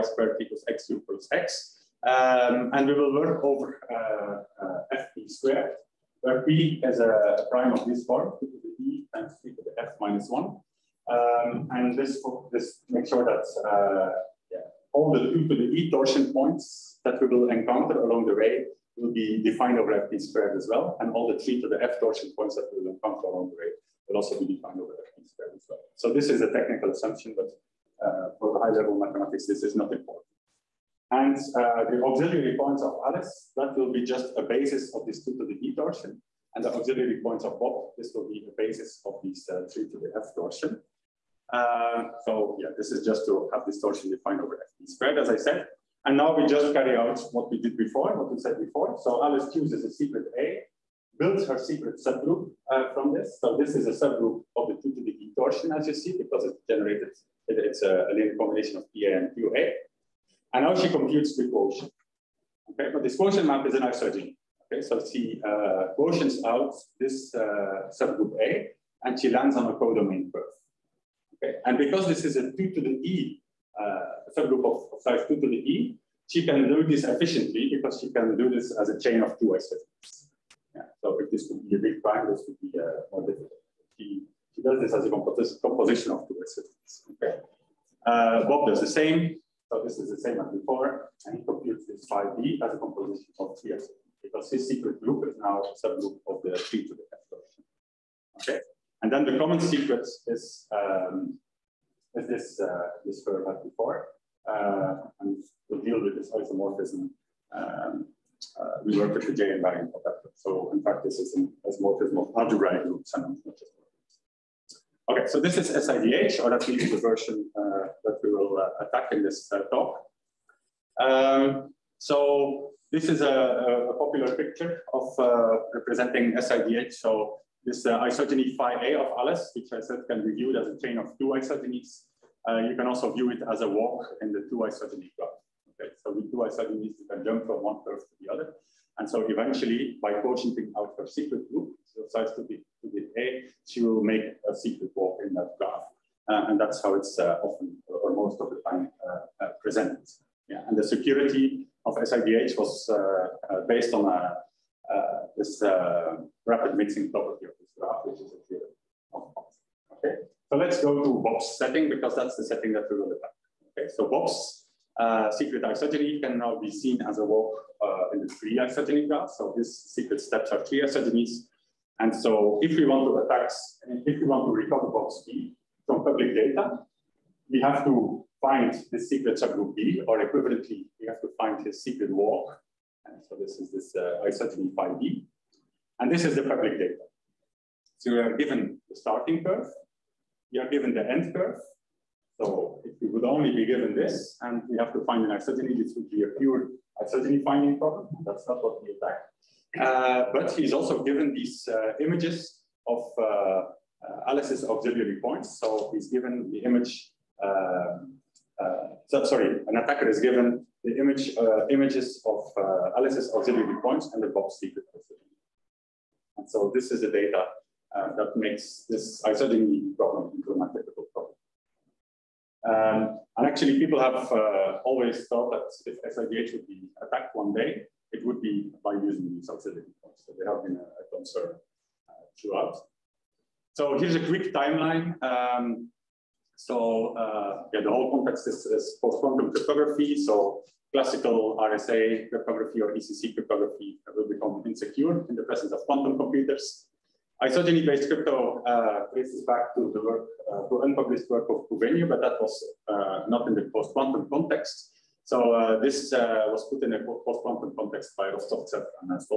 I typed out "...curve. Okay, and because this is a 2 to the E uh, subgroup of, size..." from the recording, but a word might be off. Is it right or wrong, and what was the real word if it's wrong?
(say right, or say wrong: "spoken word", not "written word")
right.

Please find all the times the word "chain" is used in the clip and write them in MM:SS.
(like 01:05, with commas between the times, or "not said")
01:18, 02:10.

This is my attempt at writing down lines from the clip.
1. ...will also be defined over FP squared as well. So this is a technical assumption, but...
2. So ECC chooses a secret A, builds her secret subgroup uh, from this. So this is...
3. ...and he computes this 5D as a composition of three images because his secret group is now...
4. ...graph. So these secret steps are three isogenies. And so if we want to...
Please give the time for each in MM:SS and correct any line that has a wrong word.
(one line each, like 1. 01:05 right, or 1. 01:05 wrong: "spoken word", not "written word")
1. 00:24 right
2. 00:49 wrong: "Alice", not "ECC"
3. 01:31 wrong: "isotopes", not "images"
4. 02:49 right.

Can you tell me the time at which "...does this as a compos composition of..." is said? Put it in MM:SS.
01:24.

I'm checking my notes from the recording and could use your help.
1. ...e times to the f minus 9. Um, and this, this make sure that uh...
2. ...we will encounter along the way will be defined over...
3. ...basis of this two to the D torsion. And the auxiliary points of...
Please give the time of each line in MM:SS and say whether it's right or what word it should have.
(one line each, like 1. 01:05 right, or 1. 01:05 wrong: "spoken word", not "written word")
1. 00:08 wrong: "1", not "9"
2. 00:17 right
3. 00:34 right.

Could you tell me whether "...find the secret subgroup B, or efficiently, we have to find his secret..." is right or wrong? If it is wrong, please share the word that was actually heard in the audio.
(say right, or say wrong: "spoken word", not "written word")
wrong: "equivalently", not "efficiently".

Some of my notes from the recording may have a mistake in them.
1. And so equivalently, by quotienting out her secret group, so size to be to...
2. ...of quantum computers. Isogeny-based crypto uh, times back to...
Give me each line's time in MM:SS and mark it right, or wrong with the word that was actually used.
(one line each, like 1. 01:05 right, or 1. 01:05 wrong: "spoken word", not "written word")
1. 02:18 wrong: "eventually", not "equivalently"
2. 04:05 wrong: "traces", not "times".